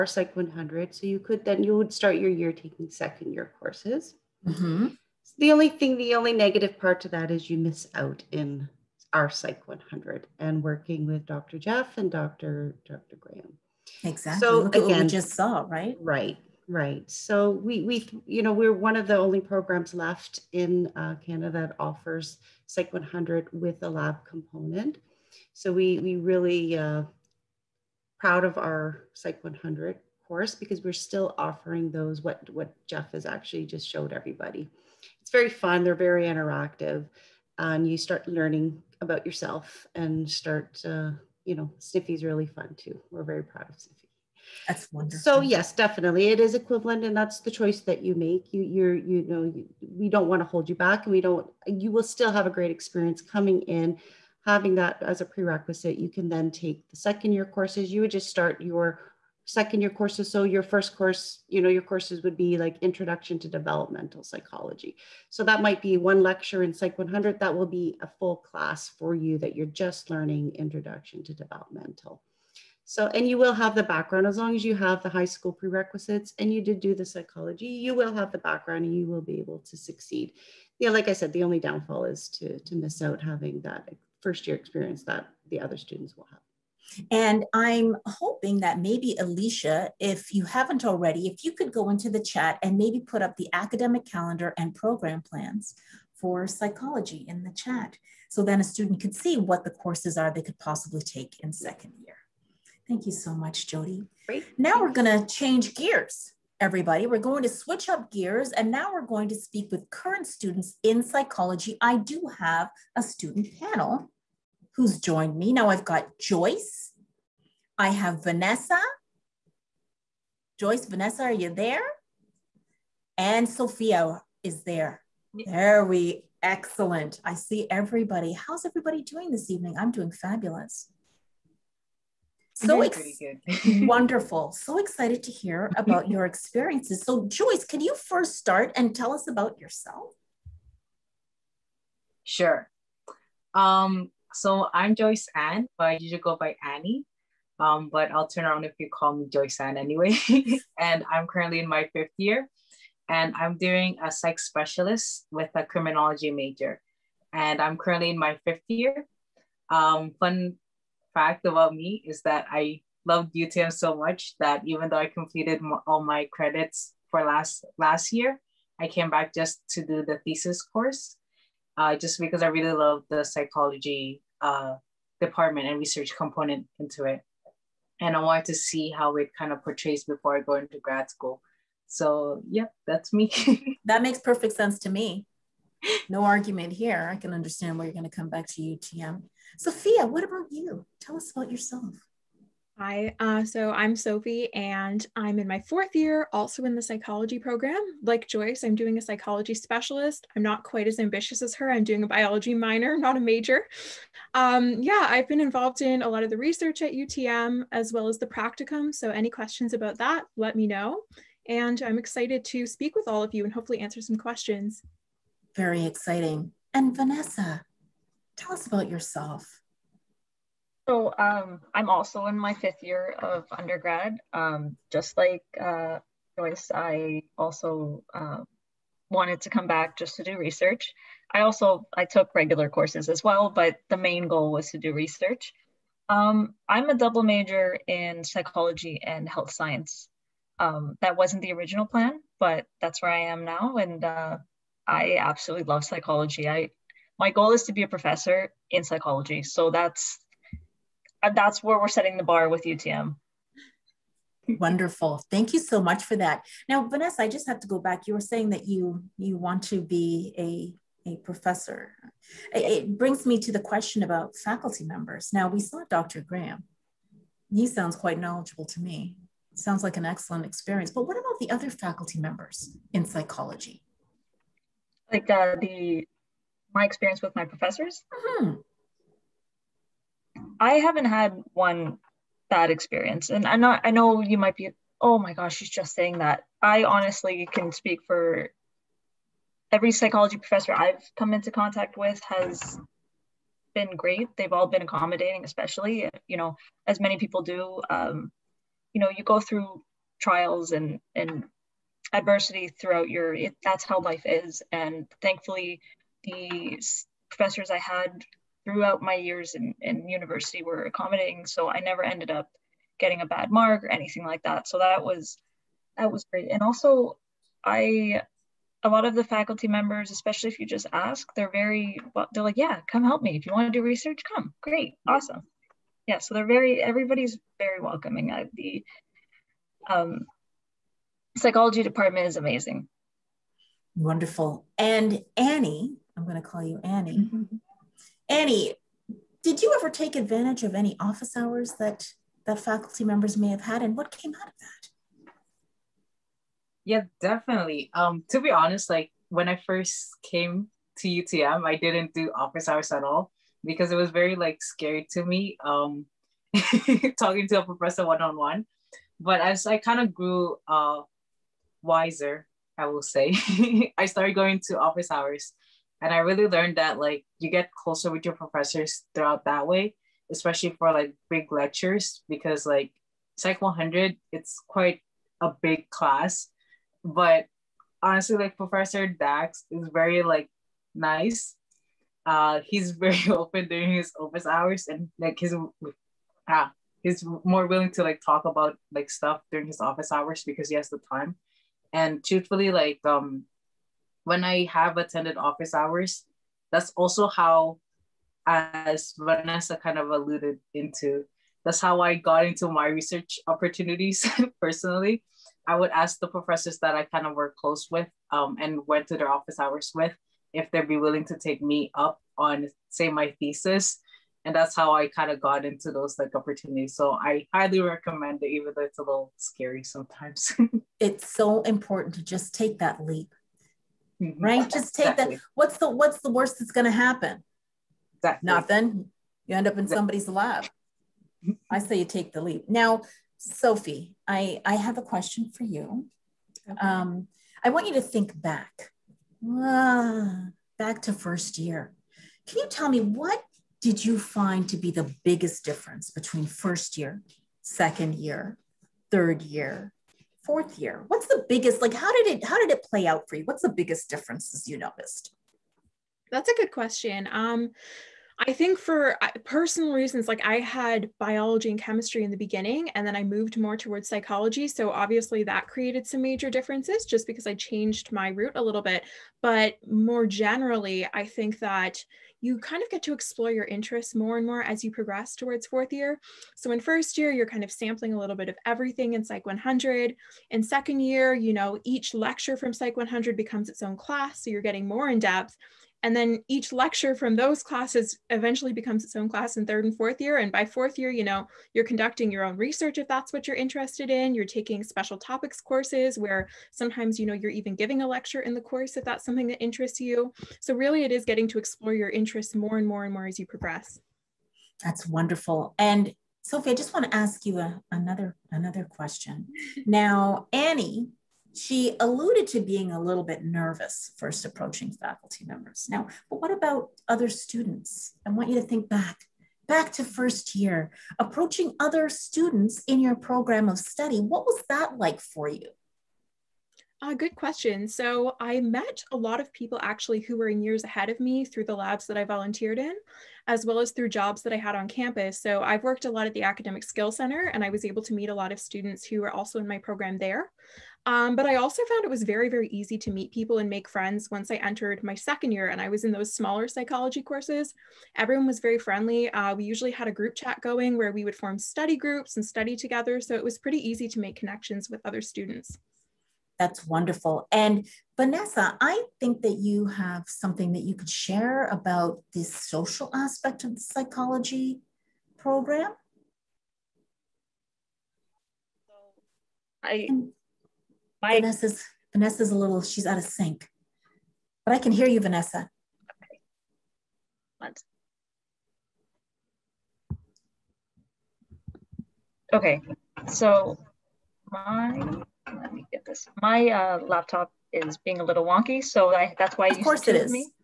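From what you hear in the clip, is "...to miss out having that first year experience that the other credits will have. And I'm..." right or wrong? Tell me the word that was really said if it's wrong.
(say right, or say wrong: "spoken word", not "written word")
wrong: "students", not "credits".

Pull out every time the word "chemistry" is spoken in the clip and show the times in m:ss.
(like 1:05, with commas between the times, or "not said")
7:41.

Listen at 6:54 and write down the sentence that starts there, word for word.
And that's how I kind of got into those like opportunities.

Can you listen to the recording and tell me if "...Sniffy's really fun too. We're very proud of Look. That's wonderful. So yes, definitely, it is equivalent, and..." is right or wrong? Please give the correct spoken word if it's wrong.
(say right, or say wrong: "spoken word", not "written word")
wrong: "Sniffy", not "Look".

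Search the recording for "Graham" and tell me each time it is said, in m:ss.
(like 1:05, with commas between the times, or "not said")
0:13, 4:26.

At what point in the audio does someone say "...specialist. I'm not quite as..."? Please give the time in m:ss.
3:19.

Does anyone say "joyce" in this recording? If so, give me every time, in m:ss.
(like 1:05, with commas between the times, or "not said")
1:56, 2:00, 2:17, 2:24, 2:29, 3:18, 3:46.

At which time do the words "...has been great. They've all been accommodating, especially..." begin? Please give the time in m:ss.
4:52.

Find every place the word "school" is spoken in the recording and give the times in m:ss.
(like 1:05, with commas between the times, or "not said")
1:15, 3:01.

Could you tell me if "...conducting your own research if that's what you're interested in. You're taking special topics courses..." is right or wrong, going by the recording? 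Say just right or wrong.
right.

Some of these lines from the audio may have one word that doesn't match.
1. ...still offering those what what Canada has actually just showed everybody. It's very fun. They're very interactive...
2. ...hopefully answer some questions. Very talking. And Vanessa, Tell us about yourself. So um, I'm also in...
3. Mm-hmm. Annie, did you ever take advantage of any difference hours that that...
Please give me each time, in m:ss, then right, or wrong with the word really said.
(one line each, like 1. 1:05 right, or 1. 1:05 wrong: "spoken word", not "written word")
1. 0:30 wrong: "Jeff", not "Canada"
2. 3:33 wrong: "exciting", not "talking"
3. 5:37 wrong: "office", not "difference".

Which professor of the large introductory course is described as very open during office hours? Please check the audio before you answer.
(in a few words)
Professor Dax.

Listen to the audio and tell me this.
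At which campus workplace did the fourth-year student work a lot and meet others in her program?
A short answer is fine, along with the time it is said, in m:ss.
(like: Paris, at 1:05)
Academic Skill Center, at 8:56.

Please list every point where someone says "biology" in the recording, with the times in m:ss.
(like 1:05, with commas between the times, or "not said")
3:22, 7:41.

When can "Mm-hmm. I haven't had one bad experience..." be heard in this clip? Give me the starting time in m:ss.
4:38.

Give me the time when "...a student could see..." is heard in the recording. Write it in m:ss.
1:38.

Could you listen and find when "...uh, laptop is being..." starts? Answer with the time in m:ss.
9:46.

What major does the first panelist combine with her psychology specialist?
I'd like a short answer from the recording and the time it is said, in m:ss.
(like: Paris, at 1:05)
criminology, at 2:35.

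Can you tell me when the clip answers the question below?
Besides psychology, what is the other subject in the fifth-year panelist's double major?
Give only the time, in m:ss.
3:59.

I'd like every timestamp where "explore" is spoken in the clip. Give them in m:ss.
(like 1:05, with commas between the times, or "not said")
7:53, 8:21.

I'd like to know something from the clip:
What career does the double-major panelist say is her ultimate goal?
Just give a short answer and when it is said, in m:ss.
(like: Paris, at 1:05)
professor in psychology, at 4:07.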